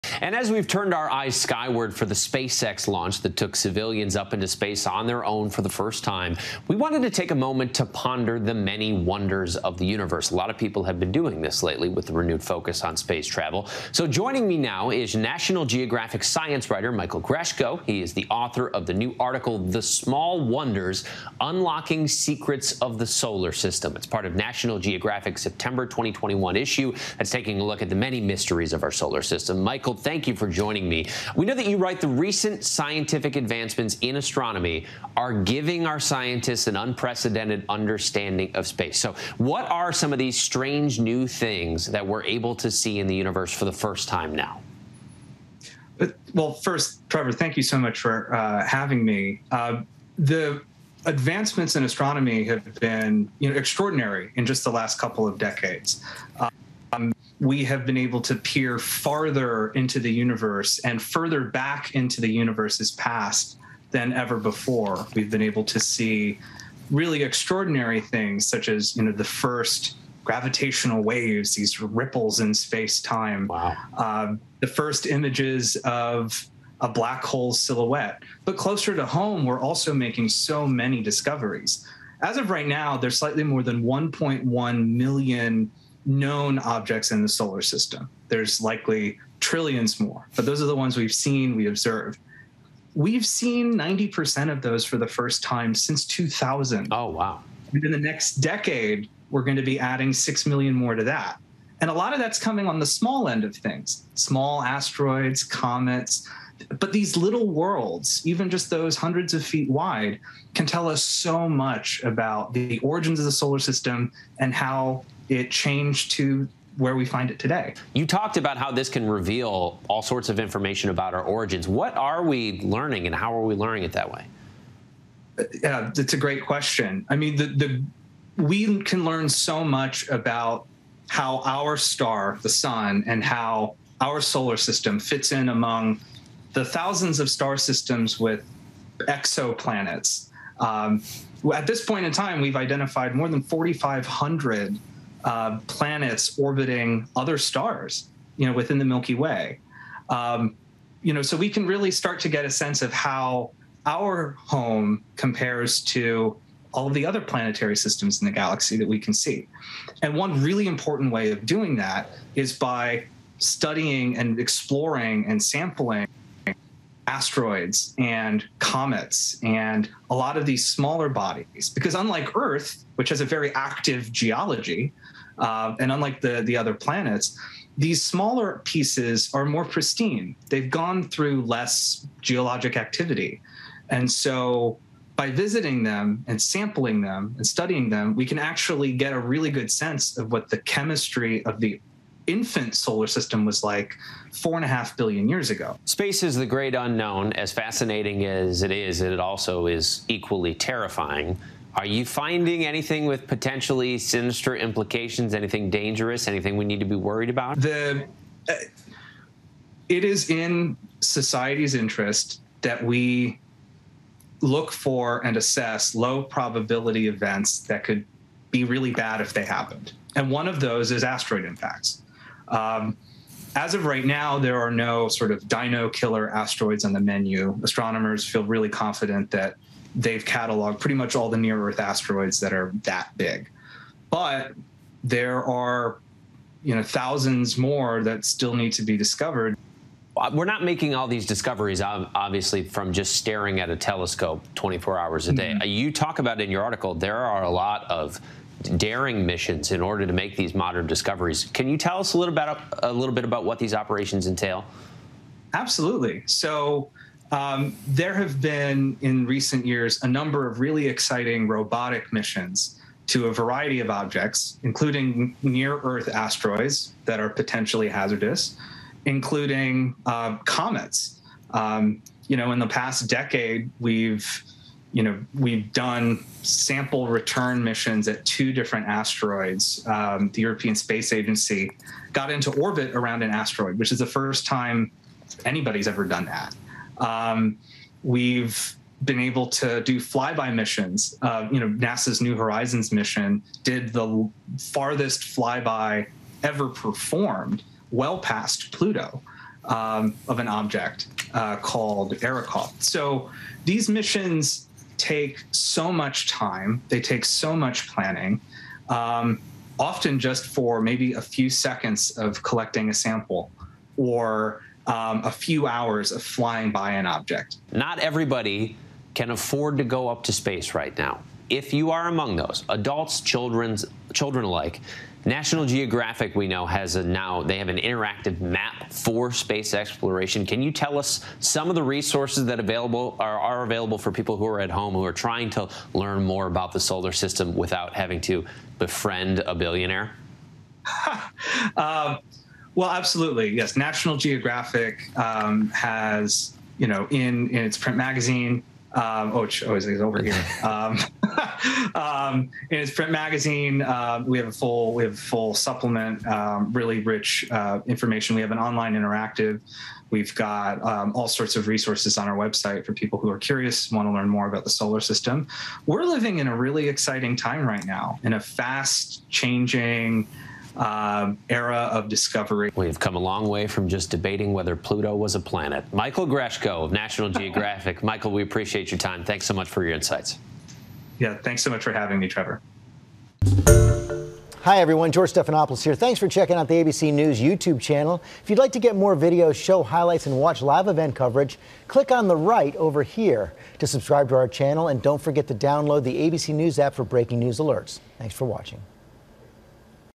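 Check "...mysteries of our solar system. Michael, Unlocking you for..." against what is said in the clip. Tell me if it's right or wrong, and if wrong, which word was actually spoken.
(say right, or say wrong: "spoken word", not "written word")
wrong: "Thank", not "Unlocking".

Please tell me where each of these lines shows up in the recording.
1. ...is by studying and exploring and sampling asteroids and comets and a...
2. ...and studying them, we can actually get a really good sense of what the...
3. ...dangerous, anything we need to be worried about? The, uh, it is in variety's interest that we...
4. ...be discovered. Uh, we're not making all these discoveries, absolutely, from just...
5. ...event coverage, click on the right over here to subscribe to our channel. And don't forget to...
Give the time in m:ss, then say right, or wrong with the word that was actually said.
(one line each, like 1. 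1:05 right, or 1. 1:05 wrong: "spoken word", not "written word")
1. 2:42 right
2. 3:07 right
3. 3:25 wrong: "society", not "variety"
4. 3:58 wrong: "obviously", not "absolutely"
5. 6:30 right.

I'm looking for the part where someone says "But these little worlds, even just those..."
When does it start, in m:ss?
1:46.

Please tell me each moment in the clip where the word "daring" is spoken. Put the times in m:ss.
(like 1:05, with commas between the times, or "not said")
4:08.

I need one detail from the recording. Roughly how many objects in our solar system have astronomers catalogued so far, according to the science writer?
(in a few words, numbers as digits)
1.1 million.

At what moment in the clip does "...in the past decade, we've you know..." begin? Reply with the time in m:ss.
4:32.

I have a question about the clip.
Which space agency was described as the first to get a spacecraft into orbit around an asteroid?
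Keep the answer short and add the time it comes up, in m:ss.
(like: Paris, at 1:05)
European Space Agency, at 4:40.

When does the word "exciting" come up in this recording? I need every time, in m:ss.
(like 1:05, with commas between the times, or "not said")
4:20, 6:06.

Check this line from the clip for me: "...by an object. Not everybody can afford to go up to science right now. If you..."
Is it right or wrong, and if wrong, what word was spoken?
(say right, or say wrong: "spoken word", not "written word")
wrong: "space", not "science".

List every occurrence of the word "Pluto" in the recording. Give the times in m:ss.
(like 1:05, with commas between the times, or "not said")
4:58, 6:14.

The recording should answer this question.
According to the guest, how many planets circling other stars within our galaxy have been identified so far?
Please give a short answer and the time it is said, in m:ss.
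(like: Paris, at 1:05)
More than 4,500, at 2:23.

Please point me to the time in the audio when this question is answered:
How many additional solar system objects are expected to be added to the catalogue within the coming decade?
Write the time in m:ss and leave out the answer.
1:40.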